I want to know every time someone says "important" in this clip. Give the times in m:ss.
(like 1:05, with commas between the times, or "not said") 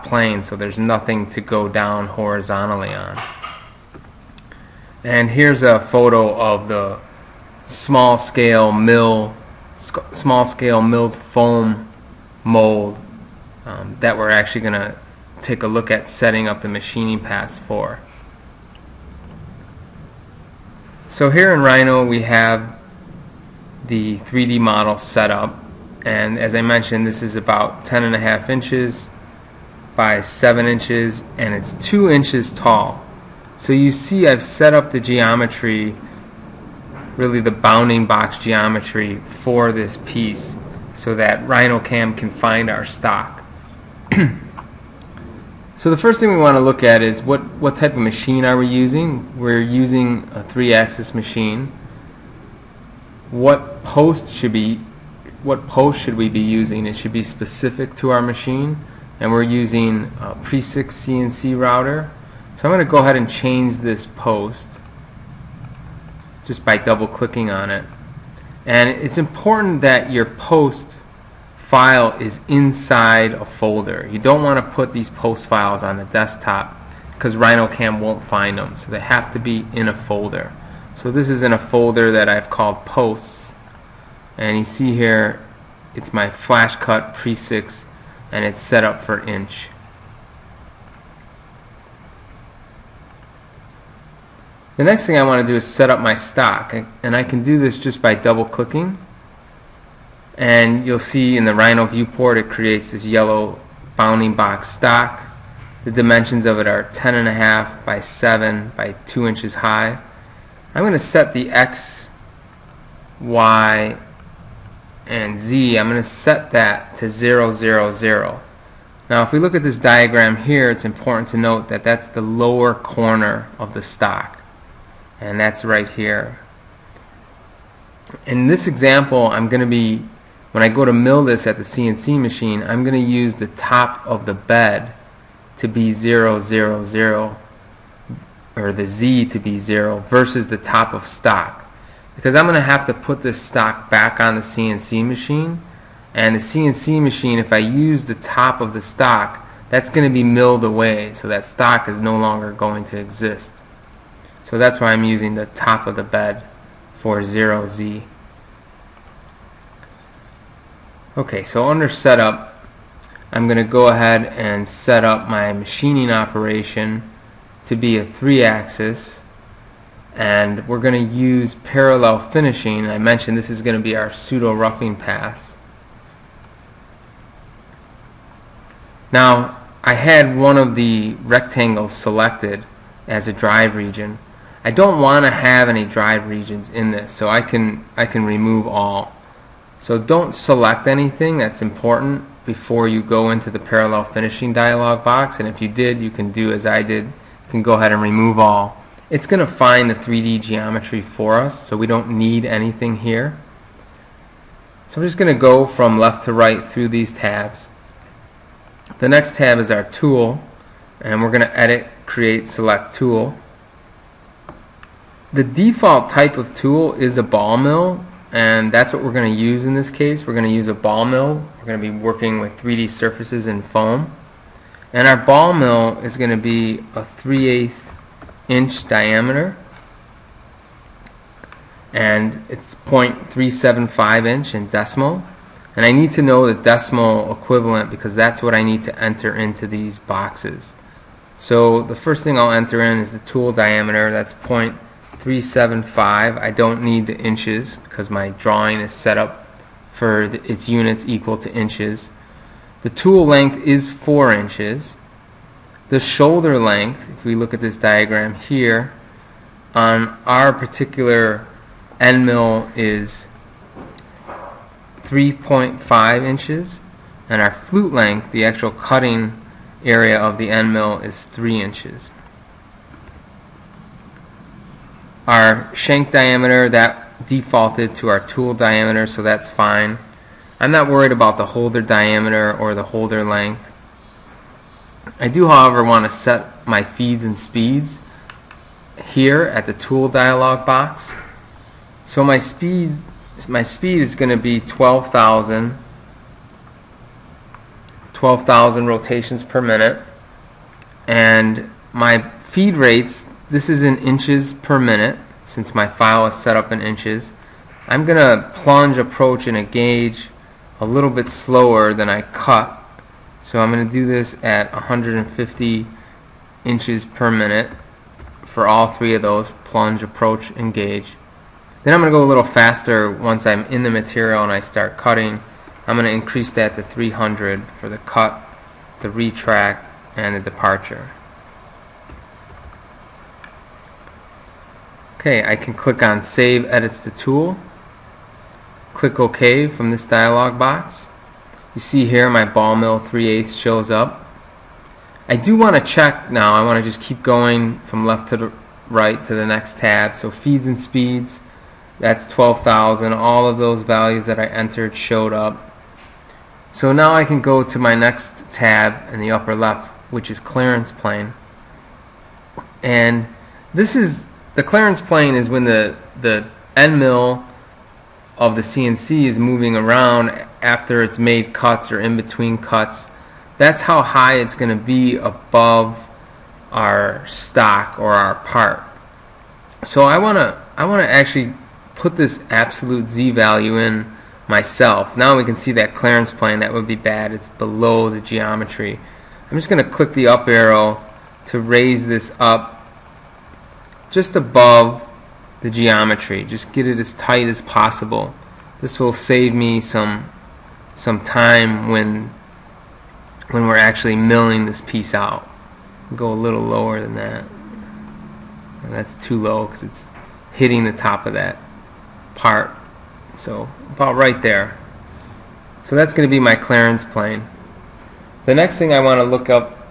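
1:09, 2:00, 3:11.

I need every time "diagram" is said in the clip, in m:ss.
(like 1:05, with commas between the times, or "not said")
1:59, 4:17.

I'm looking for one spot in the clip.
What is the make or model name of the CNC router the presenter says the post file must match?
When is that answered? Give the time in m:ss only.
1:00.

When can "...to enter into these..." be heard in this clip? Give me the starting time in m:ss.
3:58.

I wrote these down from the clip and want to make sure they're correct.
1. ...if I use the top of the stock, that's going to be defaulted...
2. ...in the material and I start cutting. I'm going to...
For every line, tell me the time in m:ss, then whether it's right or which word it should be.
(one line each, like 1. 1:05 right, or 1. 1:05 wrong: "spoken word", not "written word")
1. 2:27 wrong: "milled", not "defaulted"
2. 5:23 right.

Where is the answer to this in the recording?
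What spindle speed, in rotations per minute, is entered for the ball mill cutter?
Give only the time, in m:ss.
4:58.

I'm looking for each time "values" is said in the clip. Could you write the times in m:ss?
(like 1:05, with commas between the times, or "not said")
5:53, 6:23.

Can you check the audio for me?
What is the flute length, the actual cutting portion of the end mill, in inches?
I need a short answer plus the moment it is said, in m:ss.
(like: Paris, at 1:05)
3 inches, at 4:31.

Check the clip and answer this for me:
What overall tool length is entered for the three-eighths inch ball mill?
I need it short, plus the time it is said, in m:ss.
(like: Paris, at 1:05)
4 inches, at 4:13.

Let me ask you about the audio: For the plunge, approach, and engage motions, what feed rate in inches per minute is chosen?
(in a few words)
150.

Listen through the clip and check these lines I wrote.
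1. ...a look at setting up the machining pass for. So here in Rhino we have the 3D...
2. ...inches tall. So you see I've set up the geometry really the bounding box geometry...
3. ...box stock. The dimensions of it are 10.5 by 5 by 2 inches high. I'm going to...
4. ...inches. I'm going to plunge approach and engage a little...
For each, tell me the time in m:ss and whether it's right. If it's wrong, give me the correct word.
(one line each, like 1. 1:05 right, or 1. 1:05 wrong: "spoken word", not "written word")
1. 0:15 right
2. 0:32 right
3. 1:44 wrong: "7", not "5"
4. 5:06 right.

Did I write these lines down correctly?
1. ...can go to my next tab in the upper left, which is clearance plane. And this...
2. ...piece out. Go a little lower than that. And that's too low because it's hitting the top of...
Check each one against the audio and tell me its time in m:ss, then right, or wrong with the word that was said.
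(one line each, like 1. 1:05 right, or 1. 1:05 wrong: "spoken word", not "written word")
1. 5:57 right
2. 6:44 right.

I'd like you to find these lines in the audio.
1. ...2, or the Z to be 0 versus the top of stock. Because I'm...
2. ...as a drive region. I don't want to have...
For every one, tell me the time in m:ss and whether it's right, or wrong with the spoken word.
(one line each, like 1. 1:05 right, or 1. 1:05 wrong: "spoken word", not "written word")
1. 2:16 wrong: "0", not "2"
2. 3:03 right.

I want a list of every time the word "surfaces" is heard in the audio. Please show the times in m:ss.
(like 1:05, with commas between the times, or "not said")
3:42.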